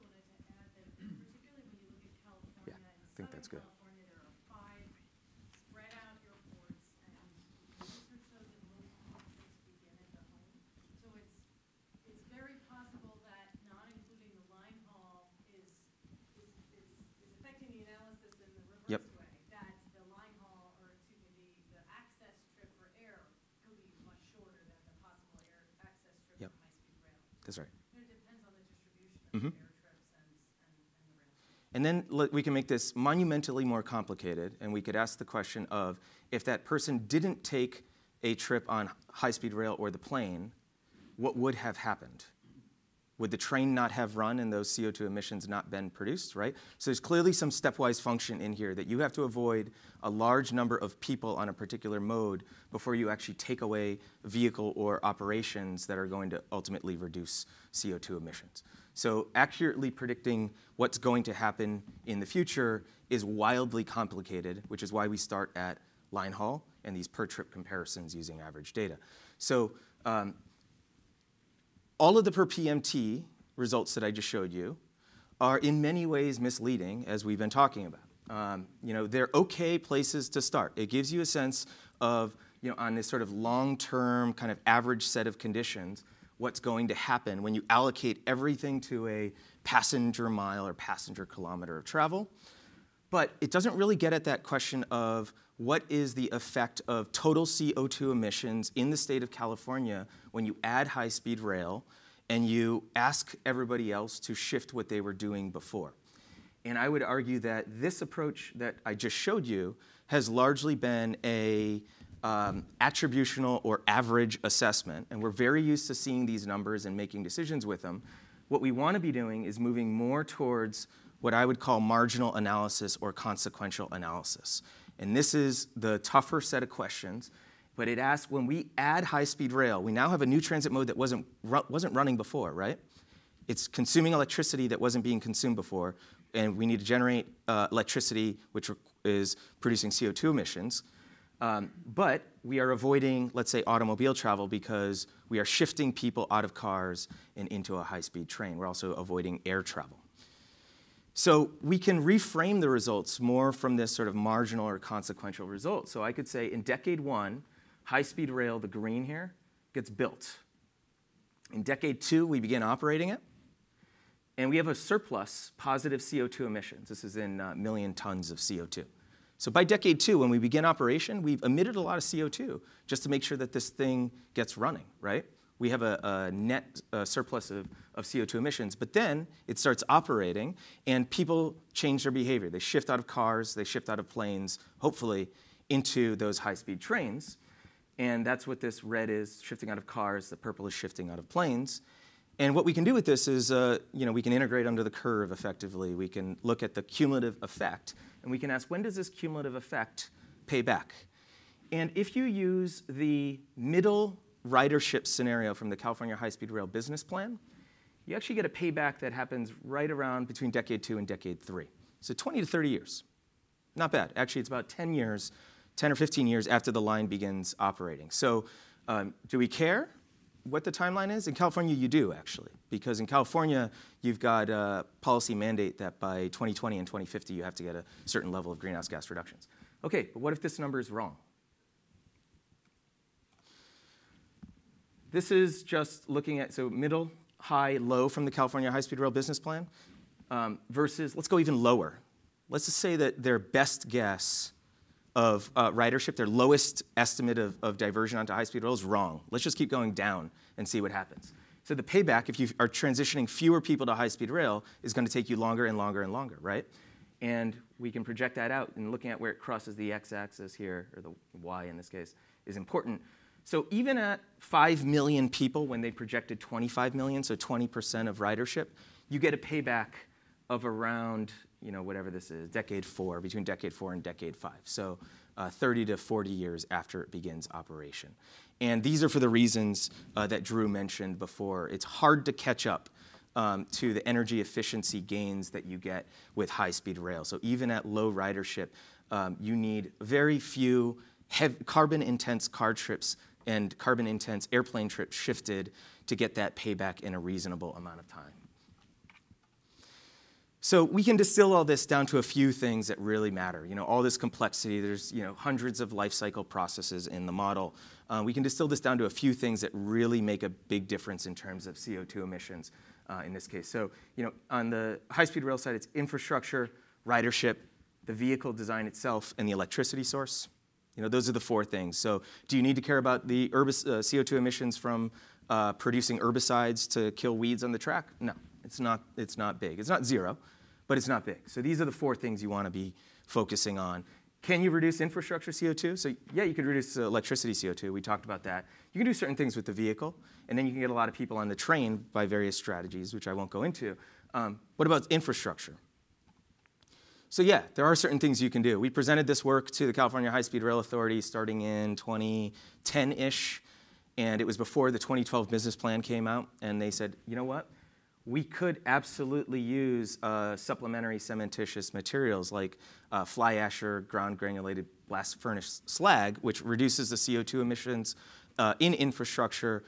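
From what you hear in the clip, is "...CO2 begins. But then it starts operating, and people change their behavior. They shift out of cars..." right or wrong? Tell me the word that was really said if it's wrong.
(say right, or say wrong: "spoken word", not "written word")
wrong: "emissions", not "begins".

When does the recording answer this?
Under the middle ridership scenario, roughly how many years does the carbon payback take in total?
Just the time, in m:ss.
3:32.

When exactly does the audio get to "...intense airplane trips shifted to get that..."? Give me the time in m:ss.
4:54.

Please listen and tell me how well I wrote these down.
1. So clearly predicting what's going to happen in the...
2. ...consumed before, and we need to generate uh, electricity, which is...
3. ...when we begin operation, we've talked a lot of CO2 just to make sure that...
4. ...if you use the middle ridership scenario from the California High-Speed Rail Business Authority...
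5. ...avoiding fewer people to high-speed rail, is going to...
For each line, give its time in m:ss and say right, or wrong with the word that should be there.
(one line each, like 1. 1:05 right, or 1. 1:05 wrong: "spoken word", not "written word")
1. 0:58 wrong: "accurately", not "clearly"
2. 2:15 right
3. 2:50 wrong: "emitted", not "talked"
4. 3:21 wrong: "Plan", not "Authority"
5. 4:12 wrong: "transitioning", not "avoiding".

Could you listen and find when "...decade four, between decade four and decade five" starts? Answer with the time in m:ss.
4:32.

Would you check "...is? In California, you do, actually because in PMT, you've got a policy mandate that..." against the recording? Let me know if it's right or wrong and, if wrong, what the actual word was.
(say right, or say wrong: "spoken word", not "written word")
wrong: "California", not "PMT".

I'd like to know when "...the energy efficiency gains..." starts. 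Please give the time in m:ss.
4:43.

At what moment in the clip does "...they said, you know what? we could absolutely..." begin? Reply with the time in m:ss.
5:56.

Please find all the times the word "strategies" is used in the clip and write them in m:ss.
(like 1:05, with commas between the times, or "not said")
5:42.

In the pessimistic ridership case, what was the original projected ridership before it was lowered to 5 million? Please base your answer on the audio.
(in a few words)
25 million.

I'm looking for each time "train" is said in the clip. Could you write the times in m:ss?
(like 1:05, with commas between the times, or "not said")
0:43, 2:28, 3:06, 5:41.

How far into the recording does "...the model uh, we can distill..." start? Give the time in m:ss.
5:07.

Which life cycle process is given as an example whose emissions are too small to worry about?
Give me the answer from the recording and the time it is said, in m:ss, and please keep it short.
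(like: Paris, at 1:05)
herbicides, at 5:26.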